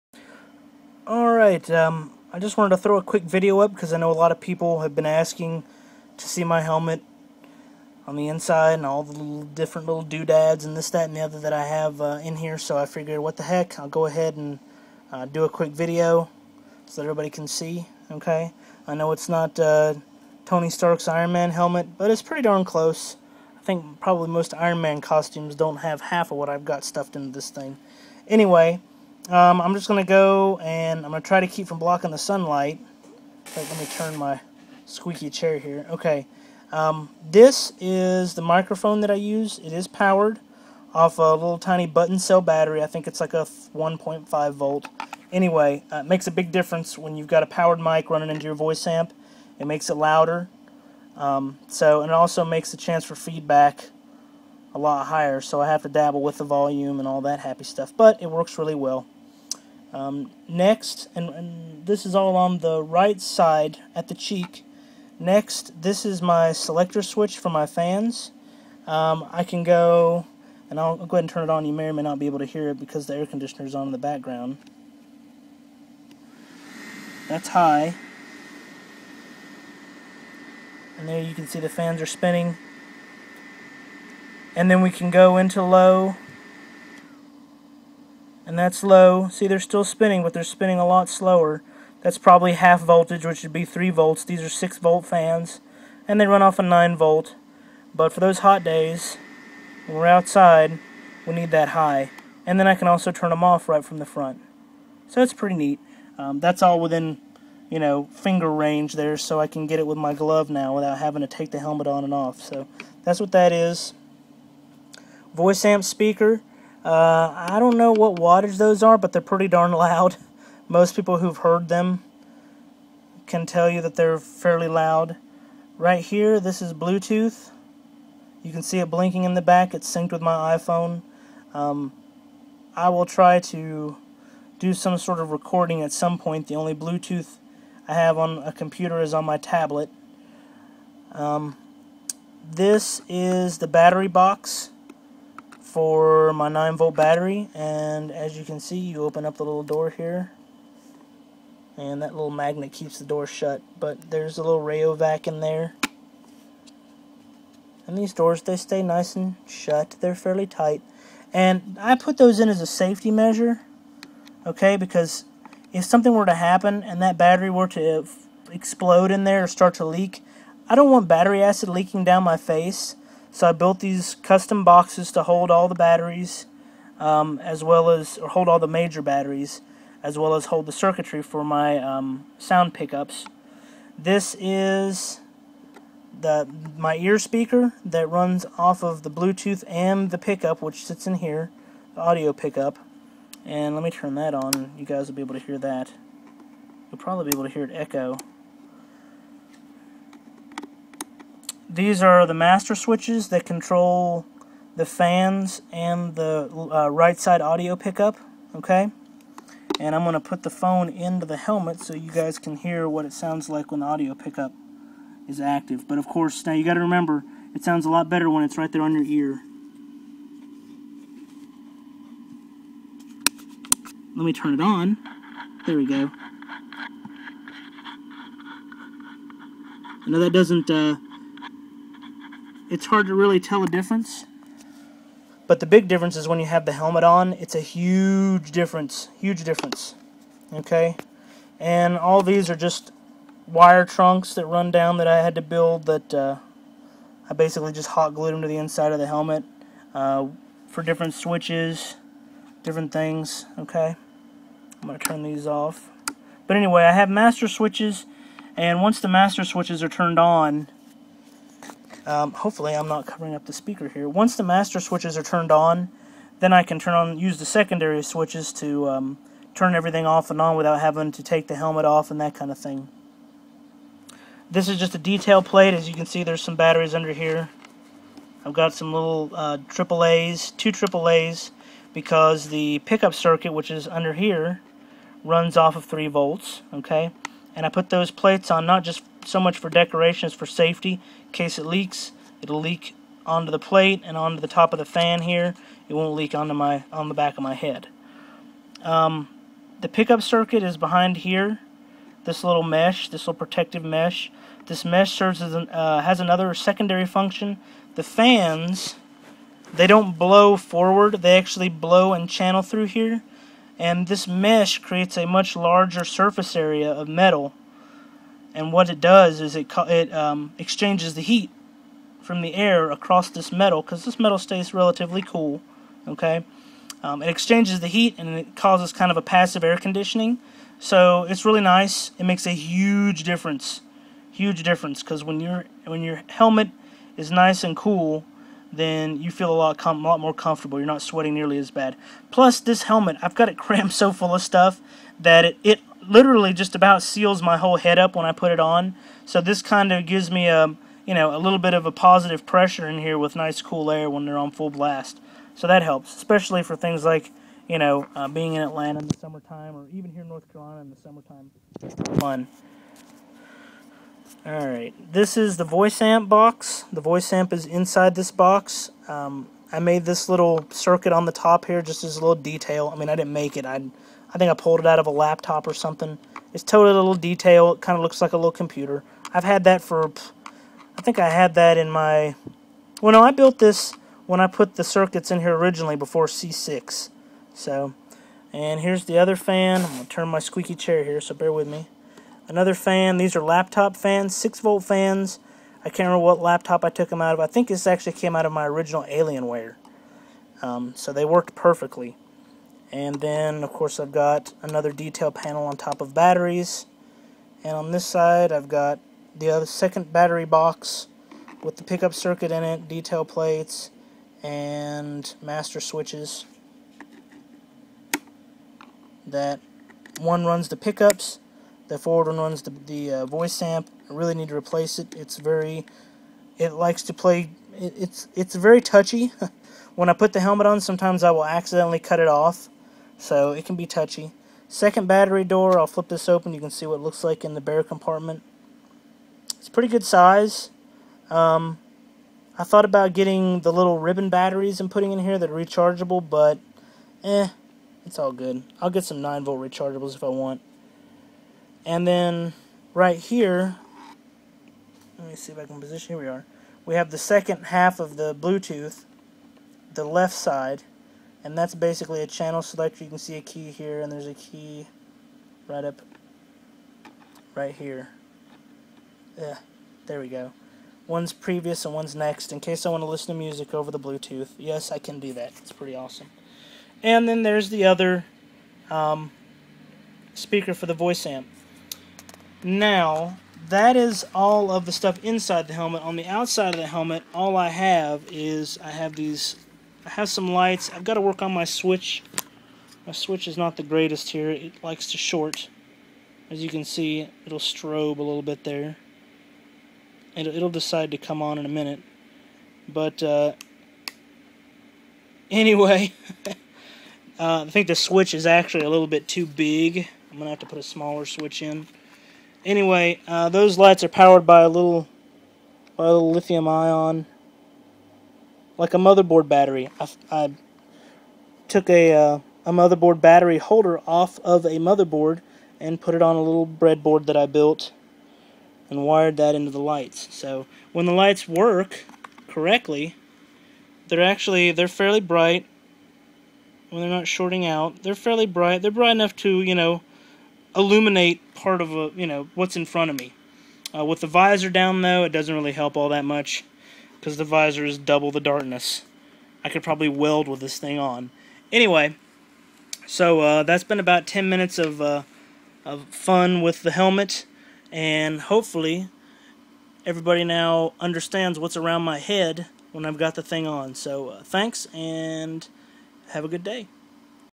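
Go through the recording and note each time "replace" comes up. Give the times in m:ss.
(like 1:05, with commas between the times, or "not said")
7:04.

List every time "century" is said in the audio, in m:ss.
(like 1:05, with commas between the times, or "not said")
not said.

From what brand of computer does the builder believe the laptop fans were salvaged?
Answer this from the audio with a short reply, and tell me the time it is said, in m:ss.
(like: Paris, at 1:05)
Alienware, at 6:39.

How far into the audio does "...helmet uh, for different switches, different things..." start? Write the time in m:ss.
4:09.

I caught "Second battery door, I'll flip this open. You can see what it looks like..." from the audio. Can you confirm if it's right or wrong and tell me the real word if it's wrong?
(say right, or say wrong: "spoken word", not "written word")
right.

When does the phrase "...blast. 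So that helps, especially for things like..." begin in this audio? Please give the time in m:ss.
5:54.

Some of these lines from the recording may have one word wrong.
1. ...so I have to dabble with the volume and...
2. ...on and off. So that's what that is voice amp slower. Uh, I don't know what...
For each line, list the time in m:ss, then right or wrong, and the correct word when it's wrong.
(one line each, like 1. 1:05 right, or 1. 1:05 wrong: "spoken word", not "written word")
1. 0:55 right
2. 1:51 wrong: "speaker", not "slower".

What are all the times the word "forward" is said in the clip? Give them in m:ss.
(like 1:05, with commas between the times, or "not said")
5:10, 7:01.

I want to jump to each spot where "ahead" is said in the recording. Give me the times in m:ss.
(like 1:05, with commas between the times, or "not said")
0:14, 1:11.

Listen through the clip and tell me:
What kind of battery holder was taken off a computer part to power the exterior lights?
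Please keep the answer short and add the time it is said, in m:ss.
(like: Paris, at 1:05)
motherboard battery holder, at 8:42.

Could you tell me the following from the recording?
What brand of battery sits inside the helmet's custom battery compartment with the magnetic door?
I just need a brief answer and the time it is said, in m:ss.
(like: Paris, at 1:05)
Rayovac, at 2:34.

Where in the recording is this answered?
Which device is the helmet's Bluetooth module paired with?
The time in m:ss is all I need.
2:10.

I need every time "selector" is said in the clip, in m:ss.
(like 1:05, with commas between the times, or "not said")
1:06, 7:42.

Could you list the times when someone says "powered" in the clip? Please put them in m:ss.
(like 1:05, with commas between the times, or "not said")
0:39, 0:47, 8:34.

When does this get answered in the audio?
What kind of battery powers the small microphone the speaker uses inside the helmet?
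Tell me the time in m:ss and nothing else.
0:41.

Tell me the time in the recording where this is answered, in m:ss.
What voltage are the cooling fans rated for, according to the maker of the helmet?
1:34.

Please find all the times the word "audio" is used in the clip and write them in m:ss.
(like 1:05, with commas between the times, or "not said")
3:12, 3:27, 3:33.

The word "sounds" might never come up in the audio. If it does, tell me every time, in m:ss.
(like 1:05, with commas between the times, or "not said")
3:02, 3:33, 3:37.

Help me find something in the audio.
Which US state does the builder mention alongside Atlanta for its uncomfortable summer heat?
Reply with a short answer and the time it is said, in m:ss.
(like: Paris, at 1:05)
North Carolina, at 6:00.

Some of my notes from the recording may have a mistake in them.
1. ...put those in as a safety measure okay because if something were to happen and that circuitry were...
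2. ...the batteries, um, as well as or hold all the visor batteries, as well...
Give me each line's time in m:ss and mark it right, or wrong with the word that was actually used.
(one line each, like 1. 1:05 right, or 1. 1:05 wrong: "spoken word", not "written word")
1. 2:41 wrong: "battery", not "circuitry"
2. 2:55 wrong: "major", not "visor".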